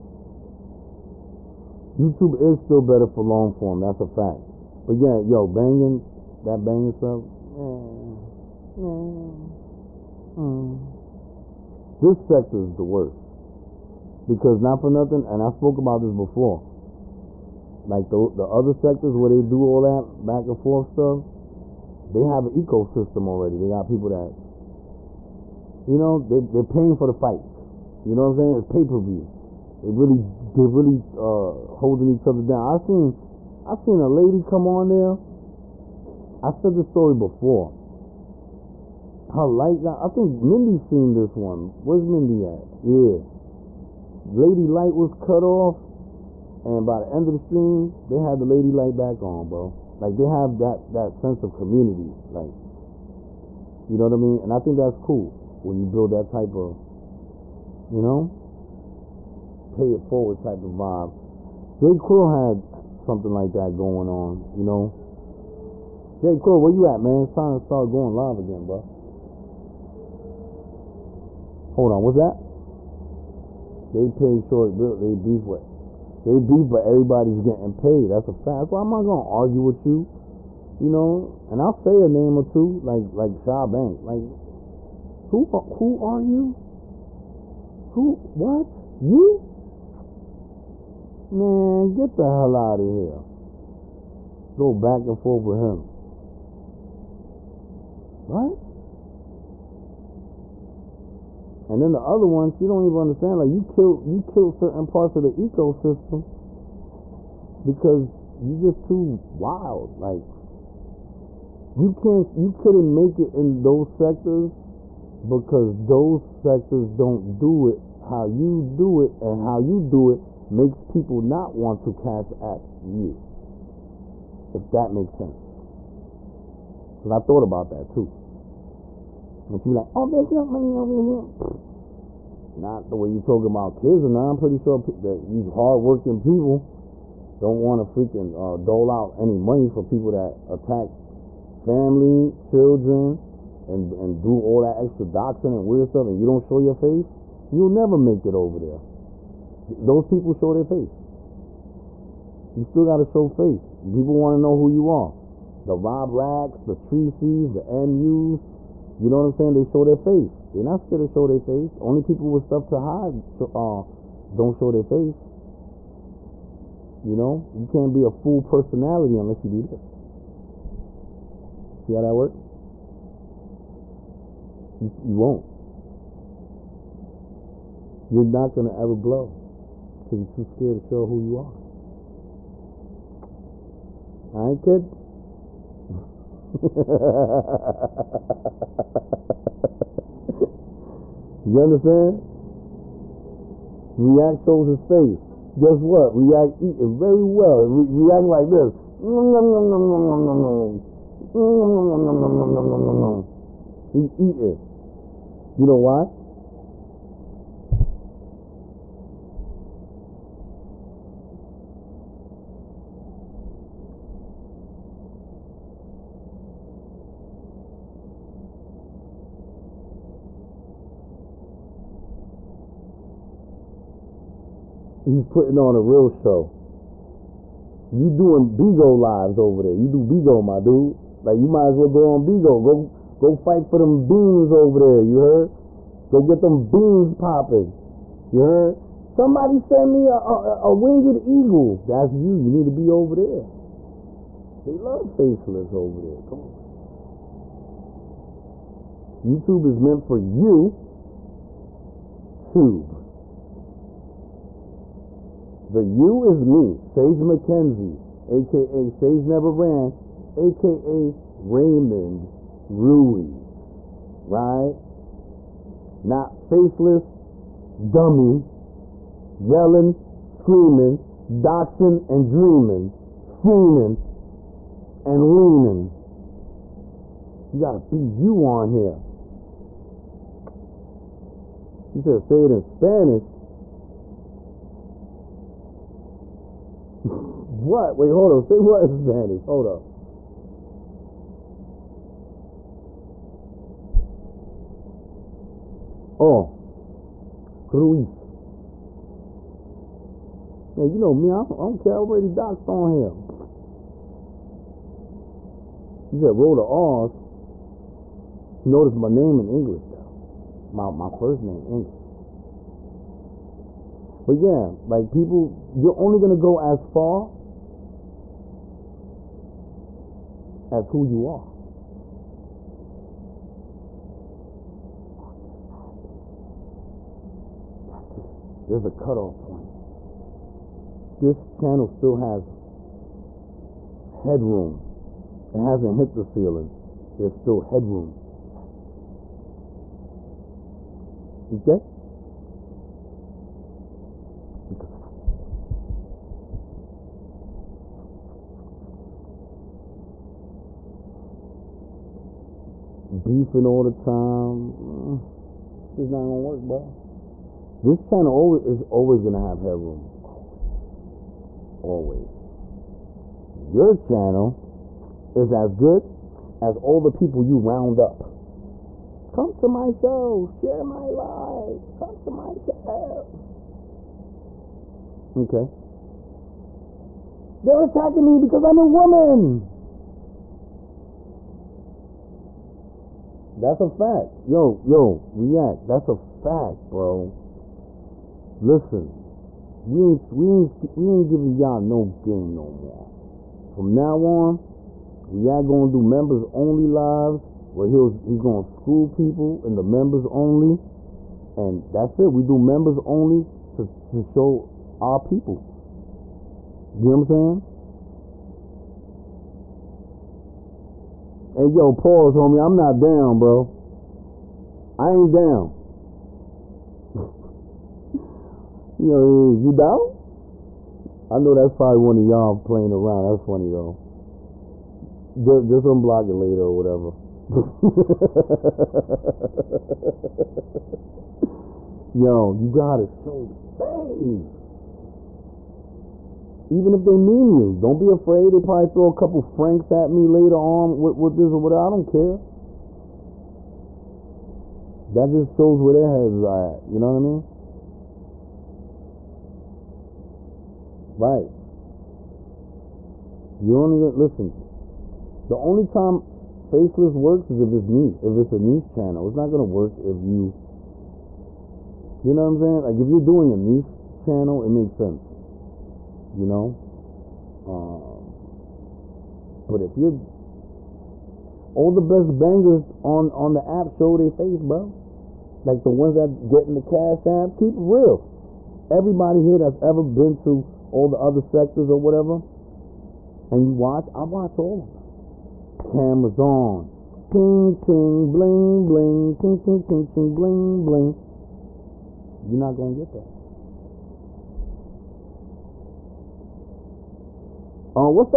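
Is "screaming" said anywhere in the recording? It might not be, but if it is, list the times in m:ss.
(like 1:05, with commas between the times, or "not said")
4:30.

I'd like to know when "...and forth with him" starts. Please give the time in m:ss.
1:35.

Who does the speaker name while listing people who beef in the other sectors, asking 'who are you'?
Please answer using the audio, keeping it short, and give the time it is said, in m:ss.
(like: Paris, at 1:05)
Shaw Bank, at 1:23.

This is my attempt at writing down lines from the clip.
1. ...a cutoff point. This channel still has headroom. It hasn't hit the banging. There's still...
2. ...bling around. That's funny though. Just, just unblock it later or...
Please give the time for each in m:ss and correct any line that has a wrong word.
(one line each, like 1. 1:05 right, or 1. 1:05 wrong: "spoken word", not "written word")
1. 5:28 wrong: "ceiling", not "banging"
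2. 7:02 wrong: "playing", not "bling".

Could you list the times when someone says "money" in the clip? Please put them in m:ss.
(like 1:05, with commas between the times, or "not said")
2:10, 2:19.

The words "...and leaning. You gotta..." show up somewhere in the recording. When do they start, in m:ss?
4:35.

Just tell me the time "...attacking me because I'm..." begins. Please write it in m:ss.
6:17.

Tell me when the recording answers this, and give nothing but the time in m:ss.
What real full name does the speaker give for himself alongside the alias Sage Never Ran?
4:21.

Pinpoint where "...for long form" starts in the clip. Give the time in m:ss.
0:03.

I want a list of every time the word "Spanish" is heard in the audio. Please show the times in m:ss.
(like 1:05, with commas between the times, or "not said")
4:42, 4:48.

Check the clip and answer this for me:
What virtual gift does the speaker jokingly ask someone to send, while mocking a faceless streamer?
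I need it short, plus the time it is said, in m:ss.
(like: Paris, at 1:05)
winged eagle, at 4:00.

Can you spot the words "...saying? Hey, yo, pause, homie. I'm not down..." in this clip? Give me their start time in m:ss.
6:47.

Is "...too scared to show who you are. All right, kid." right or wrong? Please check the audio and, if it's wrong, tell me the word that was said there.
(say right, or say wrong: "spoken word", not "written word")
right.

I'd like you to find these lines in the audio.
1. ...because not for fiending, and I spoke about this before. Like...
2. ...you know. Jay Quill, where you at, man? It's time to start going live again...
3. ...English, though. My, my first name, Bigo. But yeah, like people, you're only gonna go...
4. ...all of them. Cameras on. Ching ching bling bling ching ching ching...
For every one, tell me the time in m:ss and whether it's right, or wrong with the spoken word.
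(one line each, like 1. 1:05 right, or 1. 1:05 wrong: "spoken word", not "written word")
1. 0:14 wrong: "nothing", not "fiending"
2. 1:04 right
3. 5:09 wrong: "English", not "Bigo"
4. 8:04 right.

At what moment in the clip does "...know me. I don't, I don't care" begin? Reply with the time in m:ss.
5:00.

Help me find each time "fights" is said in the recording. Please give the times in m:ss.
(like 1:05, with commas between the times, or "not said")
0:27, 3:53.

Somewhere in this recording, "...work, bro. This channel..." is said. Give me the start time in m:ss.
5:56.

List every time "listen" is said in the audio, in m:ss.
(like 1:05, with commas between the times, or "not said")
6:28, 7:34.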